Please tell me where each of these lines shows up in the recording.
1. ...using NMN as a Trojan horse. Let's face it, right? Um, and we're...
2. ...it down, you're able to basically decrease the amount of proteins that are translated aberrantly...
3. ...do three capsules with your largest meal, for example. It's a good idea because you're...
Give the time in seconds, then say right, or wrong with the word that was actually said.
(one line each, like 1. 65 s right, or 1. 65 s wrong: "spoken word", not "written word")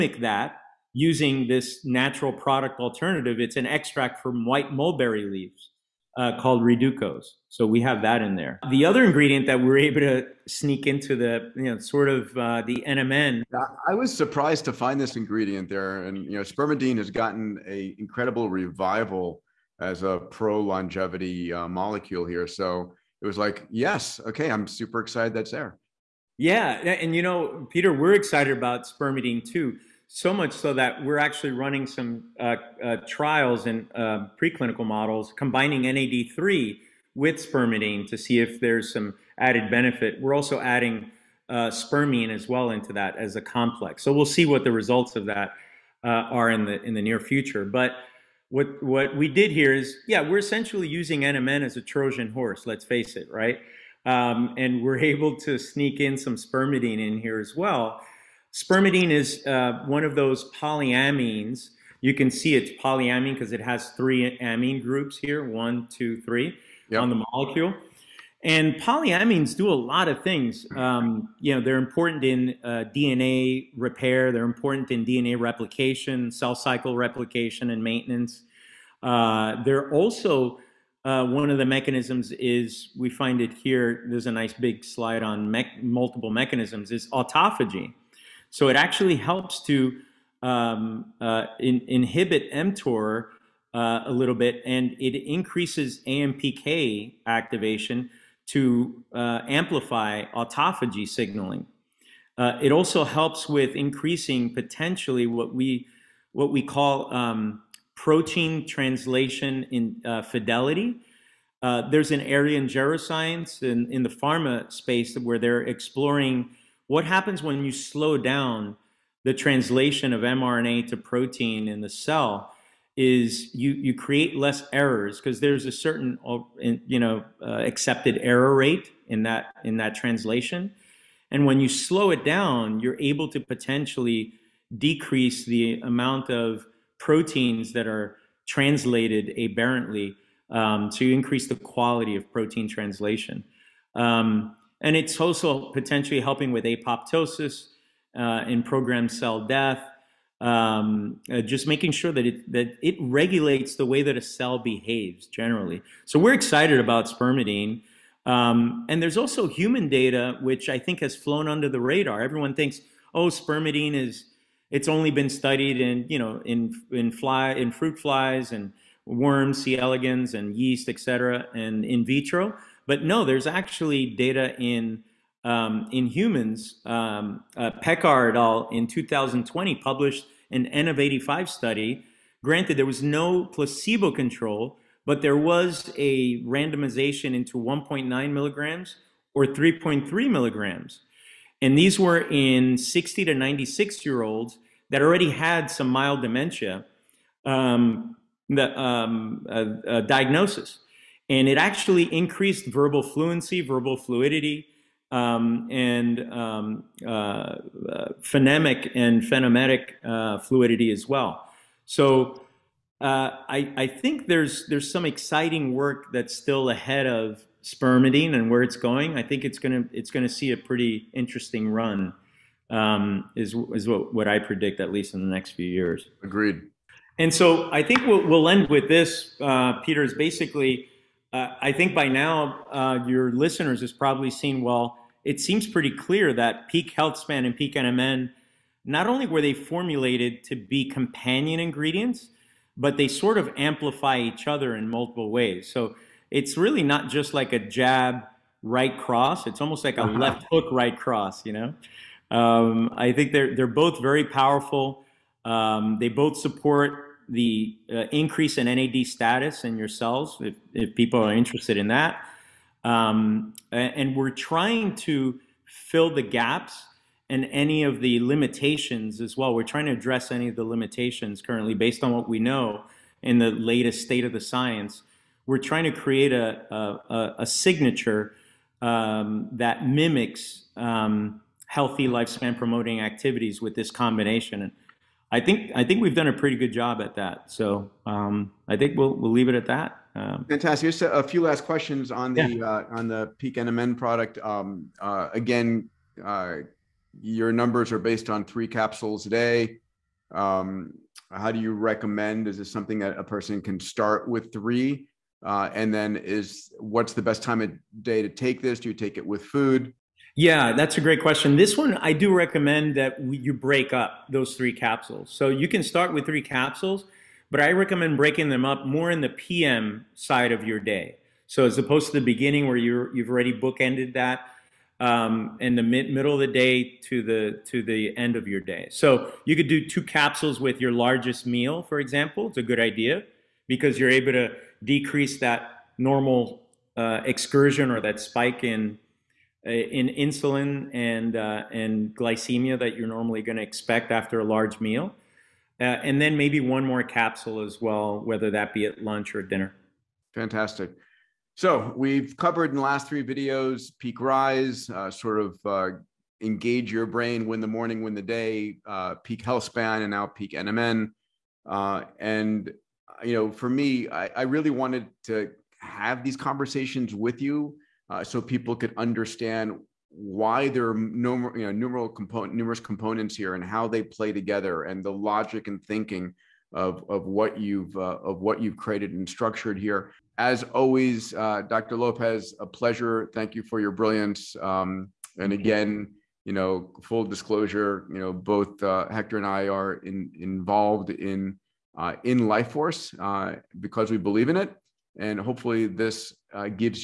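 1. 50 s right
2. 132 s wrong: "potentially", not "basically"
3. 329 s wrong: "two", not "three".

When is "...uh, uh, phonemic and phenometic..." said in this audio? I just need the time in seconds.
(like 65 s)
207 s.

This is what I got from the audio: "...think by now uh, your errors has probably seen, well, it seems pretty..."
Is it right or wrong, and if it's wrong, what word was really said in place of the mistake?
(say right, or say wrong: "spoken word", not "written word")
wrong: "listeners", not "errors".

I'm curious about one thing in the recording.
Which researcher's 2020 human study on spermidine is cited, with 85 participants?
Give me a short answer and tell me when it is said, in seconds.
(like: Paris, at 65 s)
Pekar, at 177 s.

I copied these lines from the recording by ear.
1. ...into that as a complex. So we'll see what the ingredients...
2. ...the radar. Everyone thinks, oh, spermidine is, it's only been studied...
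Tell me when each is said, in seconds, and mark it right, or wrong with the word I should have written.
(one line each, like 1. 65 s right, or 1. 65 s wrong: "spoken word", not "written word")
1. 42 s wrong: "results", not "ingredients"
2. 161 s right.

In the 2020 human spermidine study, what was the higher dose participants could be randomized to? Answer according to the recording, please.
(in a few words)
3.3 milligrams.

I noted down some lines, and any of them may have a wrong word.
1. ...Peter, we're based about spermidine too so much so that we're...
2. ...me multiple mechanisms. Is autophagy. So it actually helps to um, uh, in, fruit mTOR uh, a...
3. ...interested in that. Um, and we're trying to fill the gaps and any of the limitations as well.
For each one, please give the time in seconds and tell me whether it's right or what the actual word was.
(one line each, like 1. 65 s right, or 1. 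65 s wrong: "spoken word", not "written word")
1. 27 s wrong: "excited", not "based"
2. 85 s wrong: "inhibit", not "fruit"
3. 261 s right.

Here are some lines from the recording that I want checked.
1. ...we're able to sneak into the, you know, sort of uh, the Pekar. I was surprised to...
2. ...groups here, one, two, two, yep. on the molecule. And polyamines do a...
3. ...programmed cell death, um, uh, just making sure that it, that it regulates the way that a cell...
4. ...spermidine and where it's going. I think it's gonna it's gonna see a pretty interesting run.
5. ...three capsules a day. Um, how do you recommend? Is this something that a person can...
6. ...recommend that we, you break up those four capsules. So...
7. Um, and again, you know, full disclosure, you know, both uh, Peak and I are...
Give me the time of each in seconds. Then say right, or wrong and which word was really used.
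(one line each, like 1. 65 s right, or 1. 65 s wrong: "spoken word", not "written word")
1. 9 s wrong: "NMN", not "Pekar"
2. 64 s wrong: "three", not "two"
3. 148 s right
4. 217 s right
5. 298 s right
6. 312 s wrong: "three", not "four"
7. 384 s wrong: "Hector", not "Peak".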